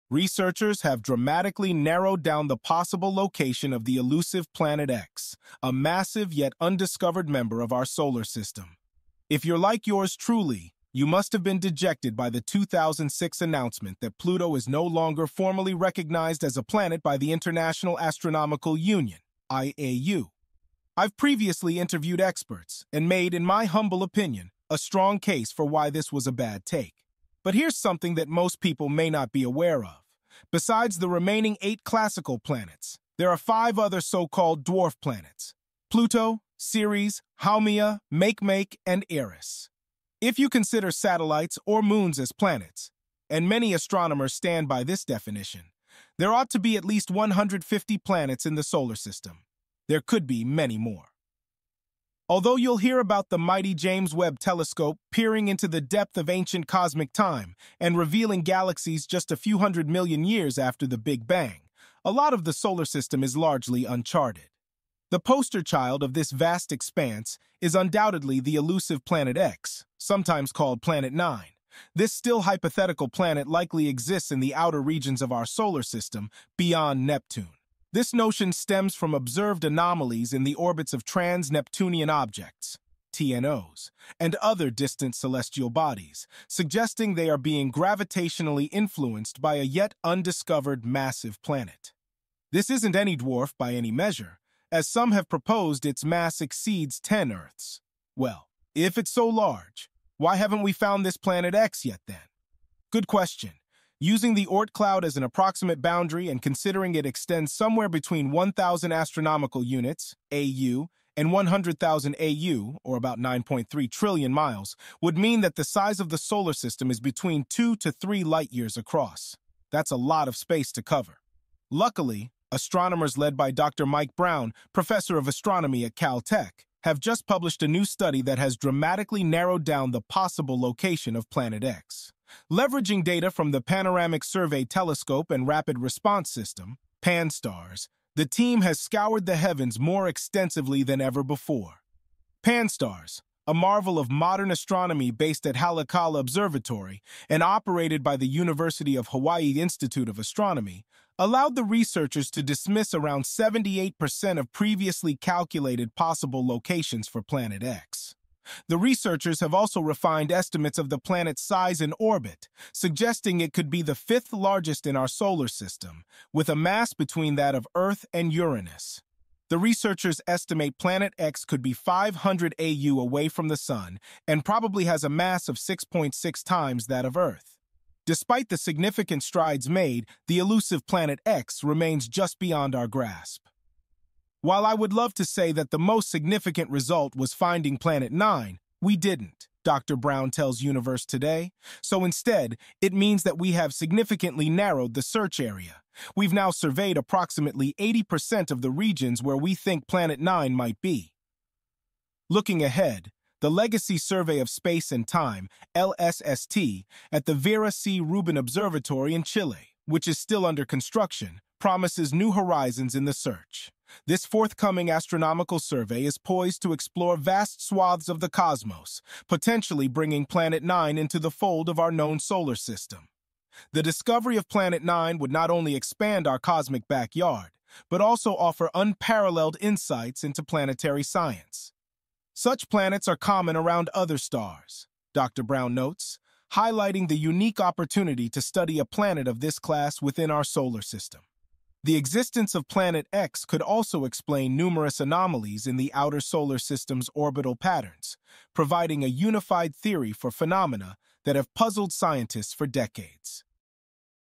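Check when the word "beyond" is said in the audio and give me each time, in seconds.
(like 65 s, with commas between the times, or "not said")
76 s, 182 s.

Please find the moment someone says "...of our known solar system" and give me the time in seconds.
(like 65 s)
221 s.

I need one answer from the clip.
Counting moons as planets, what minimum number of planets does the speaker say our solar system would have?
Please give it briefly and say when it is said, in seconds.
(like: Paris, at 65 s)
150, at 47 s.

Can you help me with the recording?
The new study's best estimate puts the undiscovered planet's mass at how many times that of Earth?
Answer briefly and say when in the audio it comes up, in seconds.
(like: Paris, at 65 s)
6.6, at 175 s.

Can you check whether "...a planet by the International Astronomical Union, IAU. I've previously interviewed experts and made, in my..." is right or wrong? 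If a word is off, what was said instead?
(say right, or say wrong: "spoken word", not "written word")
right.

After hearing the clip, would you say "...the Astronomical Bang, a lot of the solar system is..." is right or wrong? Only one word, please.
wrong.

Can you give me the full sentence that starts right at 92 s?
This isn't any dwarf by any measure, as some have proposed its mass exceeds 10 Earths.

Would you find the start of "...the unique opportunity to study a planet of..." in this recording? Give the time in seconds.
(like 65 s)
237 s.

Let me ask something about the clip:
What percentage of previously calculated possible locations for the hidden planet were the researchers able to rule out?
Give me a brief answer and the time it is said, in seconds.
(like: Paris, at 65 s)
78%, at 153 s.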